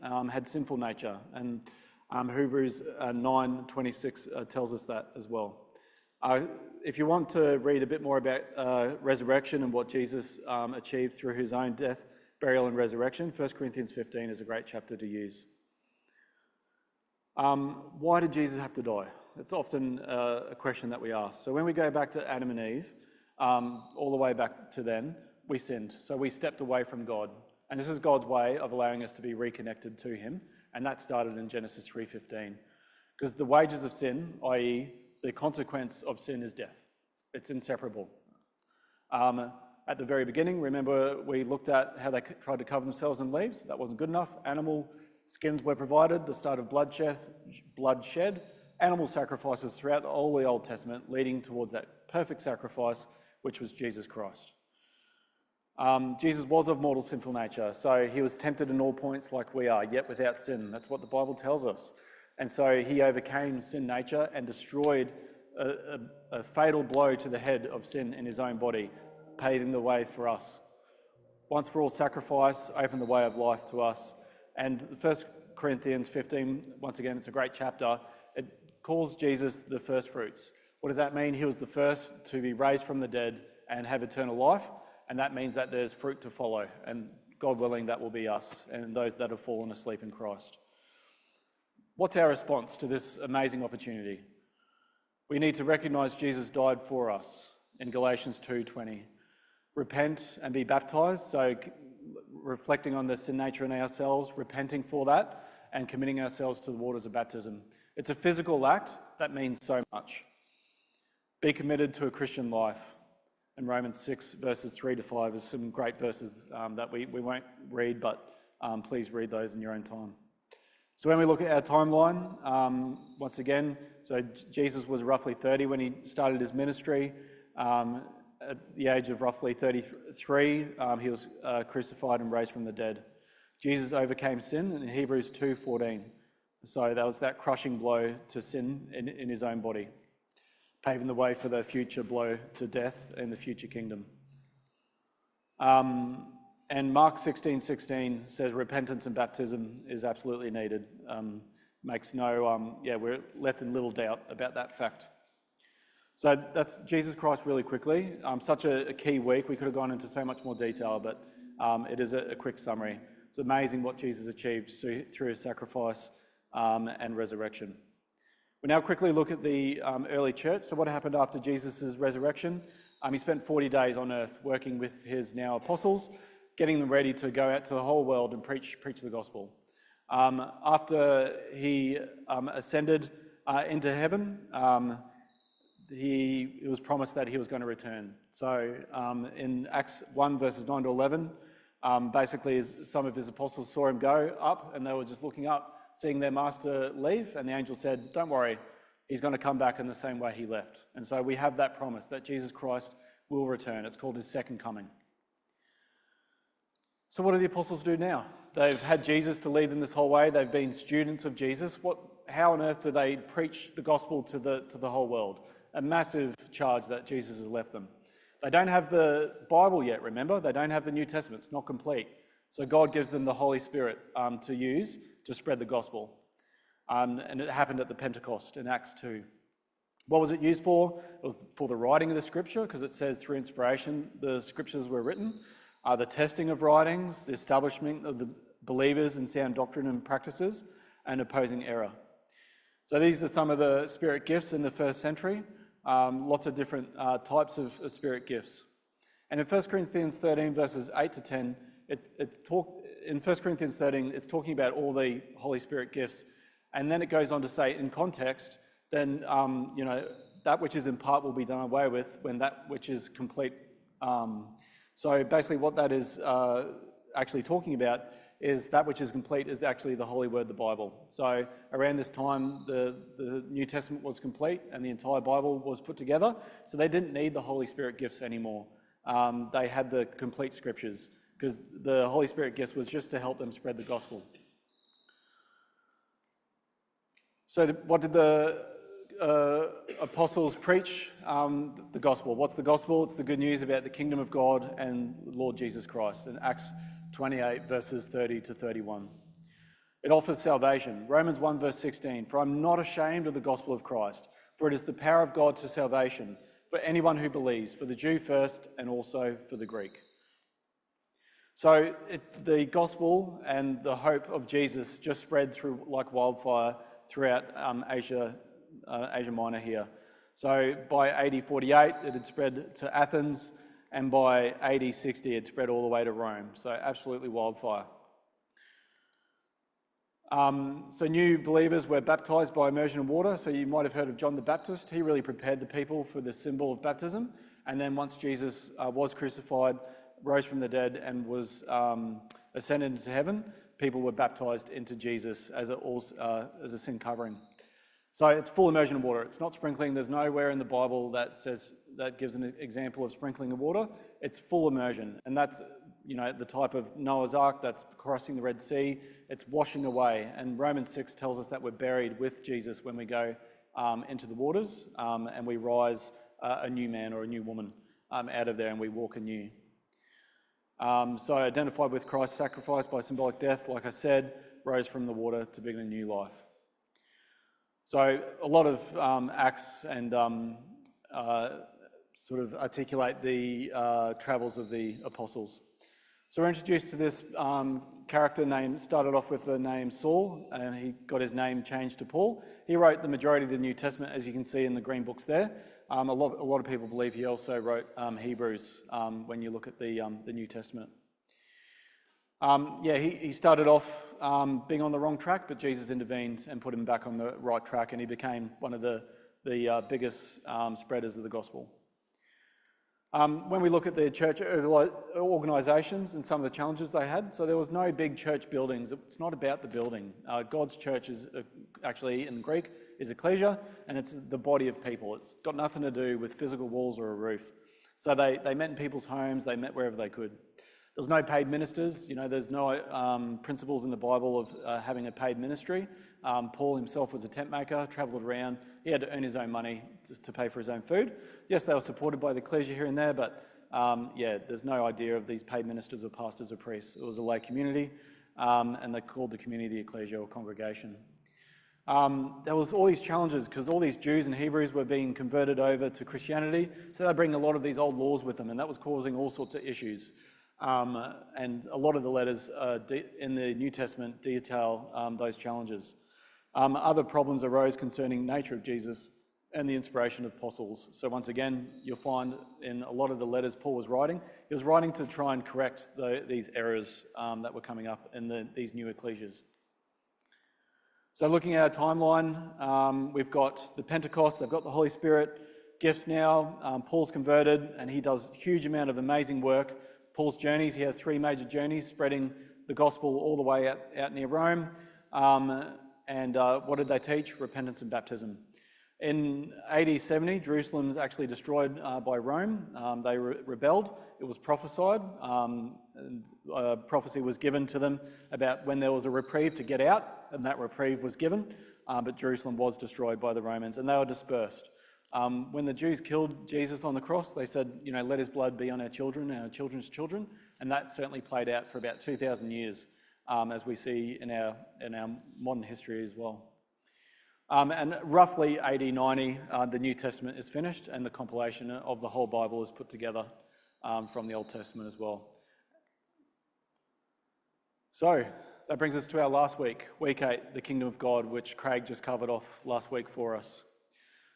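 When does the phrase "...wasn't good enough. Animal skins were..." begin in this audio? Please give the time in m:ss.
0:43.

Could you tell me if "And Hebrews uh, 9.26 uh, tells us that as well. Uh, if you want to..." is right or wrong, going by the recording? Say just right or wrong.
right.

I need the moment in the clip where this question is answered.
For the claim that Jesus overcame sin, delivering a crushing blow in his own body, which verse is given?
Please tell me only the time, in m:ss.
2:14.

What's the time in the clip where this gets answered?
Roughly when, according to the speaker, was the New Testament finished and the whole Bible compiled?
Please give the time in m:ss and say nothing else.
8:48.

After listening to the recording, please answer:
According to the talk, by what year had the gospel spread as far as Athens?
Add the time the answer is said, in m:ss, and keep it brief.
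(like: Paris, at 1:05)
AD 48, at 5:21.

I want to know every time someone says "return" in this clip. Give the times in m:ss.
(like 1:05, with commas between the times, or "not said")
3:07, 3:23.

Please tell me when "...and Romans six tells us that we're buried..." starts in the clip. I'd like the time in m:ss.
6:00.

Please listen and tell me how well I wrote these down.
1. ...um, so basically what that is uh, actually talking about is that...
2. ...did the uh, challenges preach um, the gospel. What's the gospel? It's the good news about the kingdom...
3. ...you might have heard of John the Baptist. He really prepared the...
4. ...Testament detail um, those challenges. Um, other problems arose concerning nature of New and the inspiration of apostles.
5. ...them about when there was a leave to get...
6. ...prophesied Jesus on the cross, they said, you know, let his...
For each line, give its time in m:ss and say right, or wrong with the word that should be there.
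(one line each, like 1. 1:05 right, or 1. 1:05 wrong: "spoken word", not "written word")
1. 4:24 right
2. 4:48 wrong: "apostles", not "challenges"
3. 5:33 right
4. 7:43 wrong: "Jesus", not "New"
5. 8:27 wrong: "reprieve", not "leave"
6. 8:36 wrong: "killed", not "prophesied".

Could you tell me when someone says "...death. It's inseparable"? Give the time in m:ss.
0:36.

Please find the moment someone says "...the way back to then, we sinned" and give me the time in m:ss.
0:24.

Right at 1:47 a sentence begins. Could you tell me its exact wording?
It's a physical act that means so much.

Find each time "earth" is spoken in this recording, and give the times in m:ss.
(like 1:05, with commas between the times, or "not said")
2:54, 3:32.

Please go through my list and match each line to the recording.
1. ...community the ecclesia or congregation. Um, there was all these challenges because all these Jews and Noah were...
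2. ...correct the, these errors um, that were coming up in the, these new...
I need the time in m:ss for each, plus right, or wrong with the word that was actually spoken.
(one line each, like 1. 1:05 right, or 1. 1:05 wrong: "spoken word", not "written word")
1. 7:29 wrong: "Hebrews", not "Noah"
2. 7:55 right.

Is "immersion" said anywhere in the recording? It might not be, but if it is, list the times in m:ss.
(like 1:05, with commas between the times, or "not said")
5:32, 5:48, 5:54.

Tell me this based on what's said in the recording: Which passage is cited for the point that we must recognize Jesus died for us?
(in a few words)
Galatians 2:20.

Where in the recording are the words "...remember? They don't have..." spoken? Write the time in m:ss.
3:40.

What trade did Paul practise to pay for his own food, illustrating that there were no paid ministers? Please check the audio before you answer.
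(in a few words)
Tent maker.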